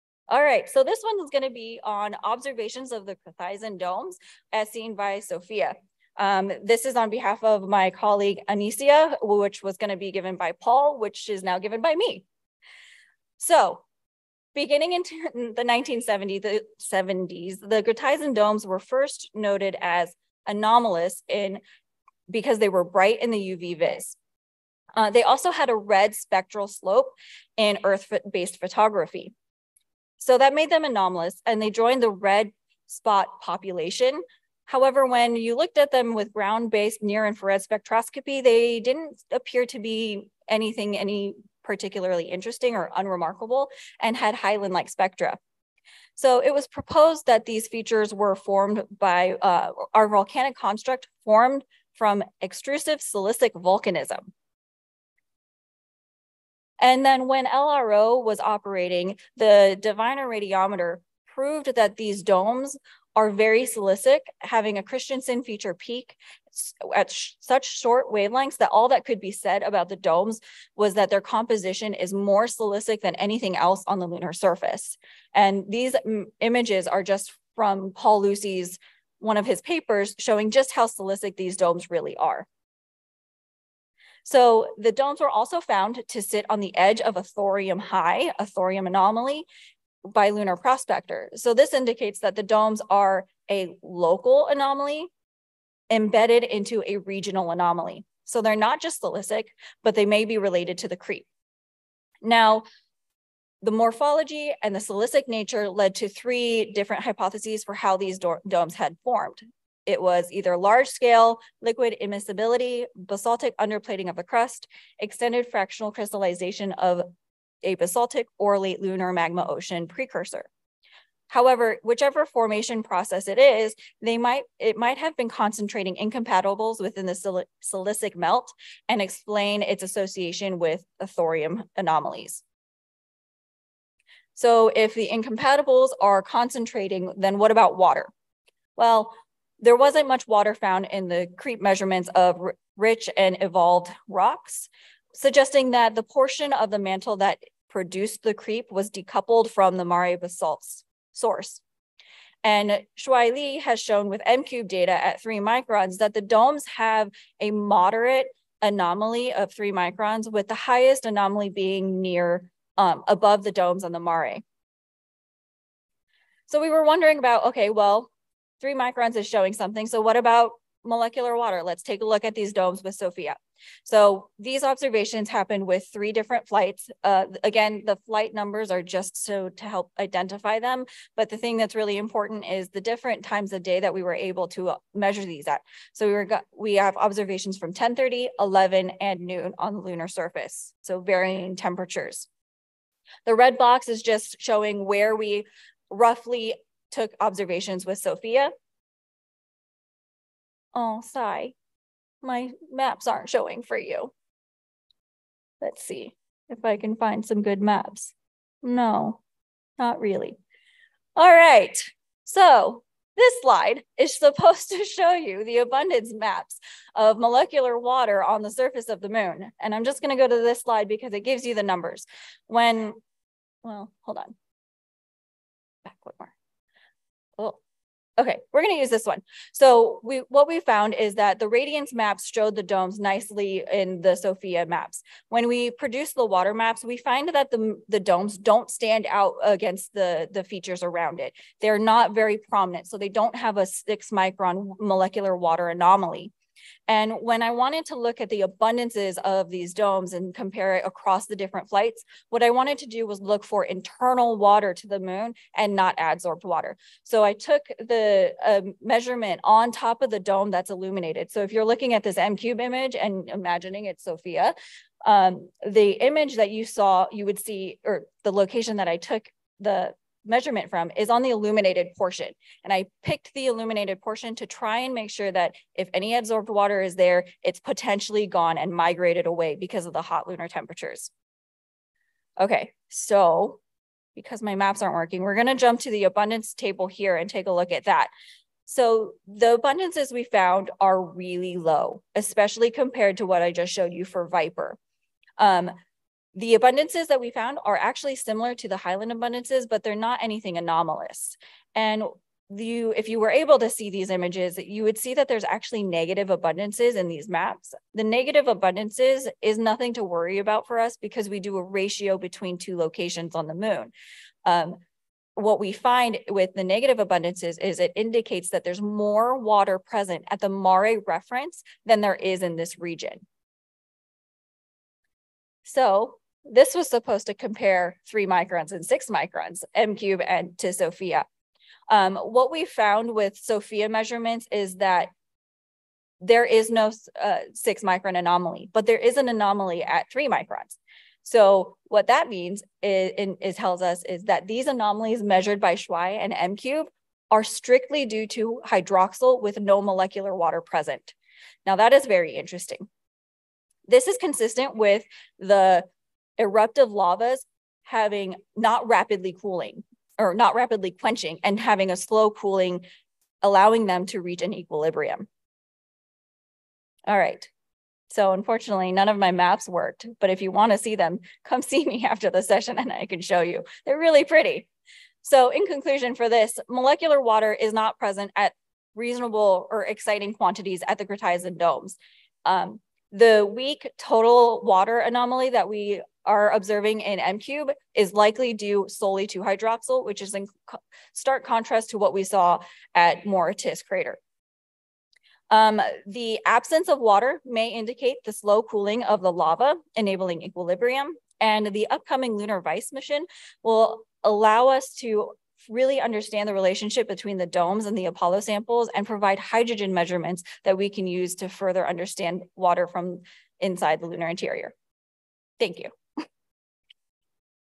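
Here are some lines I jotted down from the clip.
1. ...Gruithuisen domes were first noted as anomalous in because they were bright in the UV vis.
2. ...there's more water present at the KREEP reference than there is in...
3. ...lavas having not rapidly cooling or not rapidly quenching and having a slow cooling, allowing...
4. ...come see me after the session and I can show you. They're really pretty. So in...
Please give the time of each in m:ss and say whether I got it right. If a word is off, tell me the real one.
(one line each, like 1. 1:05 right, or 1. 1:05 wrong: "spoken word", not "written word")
1. 0:17 right
2. 5:18 wrong: "Mare", not "KREEP"
3. 5:56 right
4. 6:11 right.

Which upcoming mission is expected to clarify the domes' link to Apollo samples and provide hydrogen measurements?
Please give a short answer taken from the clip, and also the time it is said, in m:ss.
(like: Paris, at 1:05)
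Lunar-VISE, at 6:42.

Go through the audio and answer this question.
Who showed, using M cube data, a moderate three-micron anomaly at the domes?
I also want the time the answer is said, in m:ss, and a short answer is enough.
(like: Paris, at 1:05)
Shuai Li, at 2:32.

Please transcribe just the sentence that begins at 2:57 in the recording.
Uh, again, the flight numbers are just so to help identify them.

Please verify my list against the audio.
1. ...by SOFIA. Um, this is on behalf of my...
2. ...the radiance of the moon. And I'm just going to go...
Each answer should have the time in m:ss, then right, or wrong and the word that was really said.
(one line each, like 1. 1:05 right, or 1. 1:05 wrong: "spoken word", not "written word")
1. 0:04 right
2. 3:38 wrong: "surface", not "radiance".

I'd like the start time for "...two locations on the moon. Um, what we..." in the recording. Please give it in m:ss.
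5:12.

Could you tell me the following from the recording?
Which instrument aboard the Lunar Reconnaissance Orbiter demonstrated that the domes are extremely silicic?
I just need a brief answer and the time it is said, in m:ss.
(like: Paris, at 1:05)
Diviner radiometer, at 0:59.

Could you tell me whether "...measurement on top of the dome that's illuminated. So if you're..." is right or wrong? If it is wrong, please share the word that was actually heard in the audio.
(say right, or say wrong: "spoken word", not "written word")
right.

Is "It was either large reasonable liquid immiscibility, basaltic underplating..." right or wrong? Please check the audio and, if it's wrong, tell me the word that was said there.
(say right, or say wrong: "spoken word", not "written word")
wrong: "scale", not "reasonable".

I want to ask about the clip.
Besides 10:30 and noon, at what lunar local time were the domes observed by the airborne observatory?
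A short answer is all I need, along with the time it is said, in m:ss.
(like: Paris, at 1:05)
11, at 3:08.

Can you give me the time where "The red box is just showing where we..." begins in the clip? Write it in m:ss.
3:13.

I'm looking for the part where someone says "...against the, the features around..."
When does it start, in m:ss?
3:59.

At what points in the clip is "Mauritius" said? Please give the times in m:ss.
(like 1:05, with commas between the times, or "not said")
6:33.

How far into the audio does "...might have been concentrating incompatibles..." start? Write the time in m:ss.
2:04.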